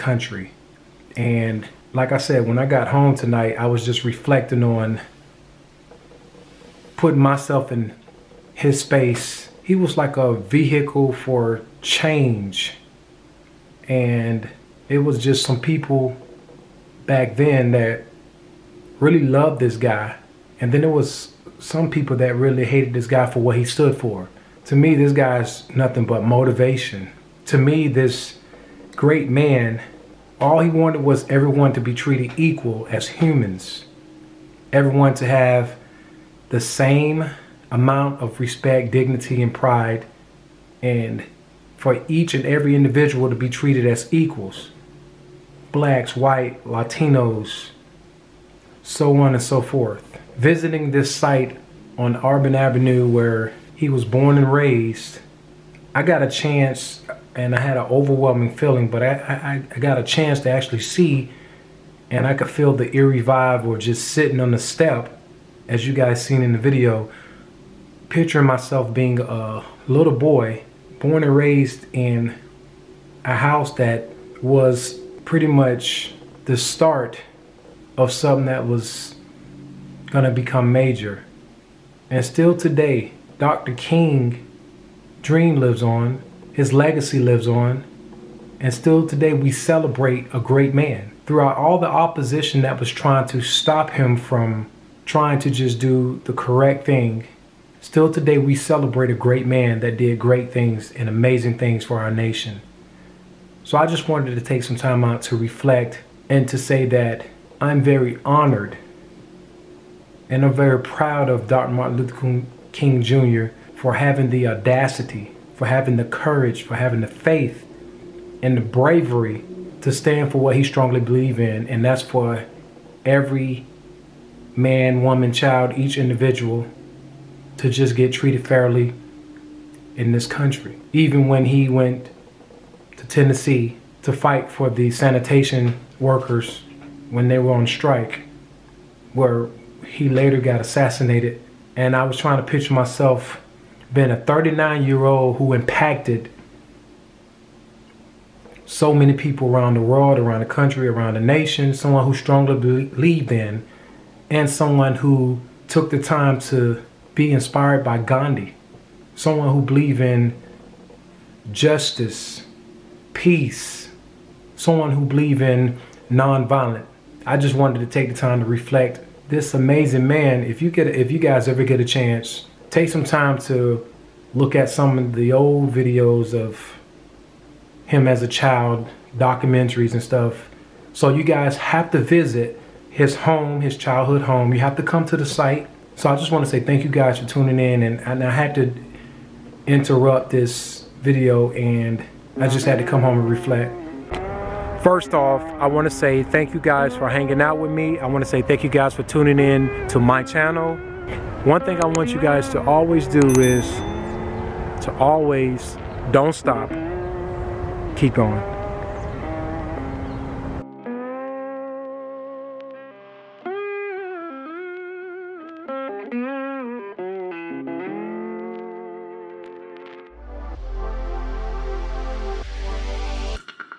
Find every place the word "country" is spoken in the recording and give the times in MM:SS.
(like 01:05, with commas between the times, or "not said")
02:10, 02:30.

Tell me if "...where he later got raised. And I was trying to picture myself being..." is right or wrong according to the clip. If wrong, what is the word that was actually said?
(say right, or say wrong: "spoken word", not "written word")
wrong: "assassinated", not "raised".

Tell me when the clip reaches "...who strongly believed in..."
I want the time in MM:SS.
02:32.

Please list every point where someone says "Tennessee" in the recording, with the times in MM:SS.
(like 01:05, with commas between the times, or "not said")
02:13.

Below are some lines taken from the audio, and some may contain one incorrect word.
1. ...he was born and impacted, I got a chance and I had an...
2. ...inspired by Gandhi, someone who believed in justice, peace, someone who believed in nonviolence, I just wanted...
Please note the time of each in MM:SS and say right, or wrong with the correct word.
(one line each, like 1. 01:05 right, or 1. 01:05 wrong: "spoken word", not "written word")
1. 00:53 wrong: "raised", not "impacted"
2. 02:37 right.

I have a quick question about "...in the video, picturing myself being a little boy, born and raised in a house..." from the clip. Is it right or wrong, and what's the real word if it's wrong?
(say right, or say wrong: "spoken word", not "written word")
right.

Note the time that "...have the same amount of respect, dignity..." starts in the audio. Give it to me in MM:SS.
00:35.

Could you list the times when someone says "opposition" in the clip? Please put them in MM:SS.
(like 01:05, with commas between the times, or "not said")
01:31.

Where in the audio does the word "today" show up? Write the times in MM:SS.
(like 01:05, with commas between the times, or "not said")
01:22, 01:29, 01:38.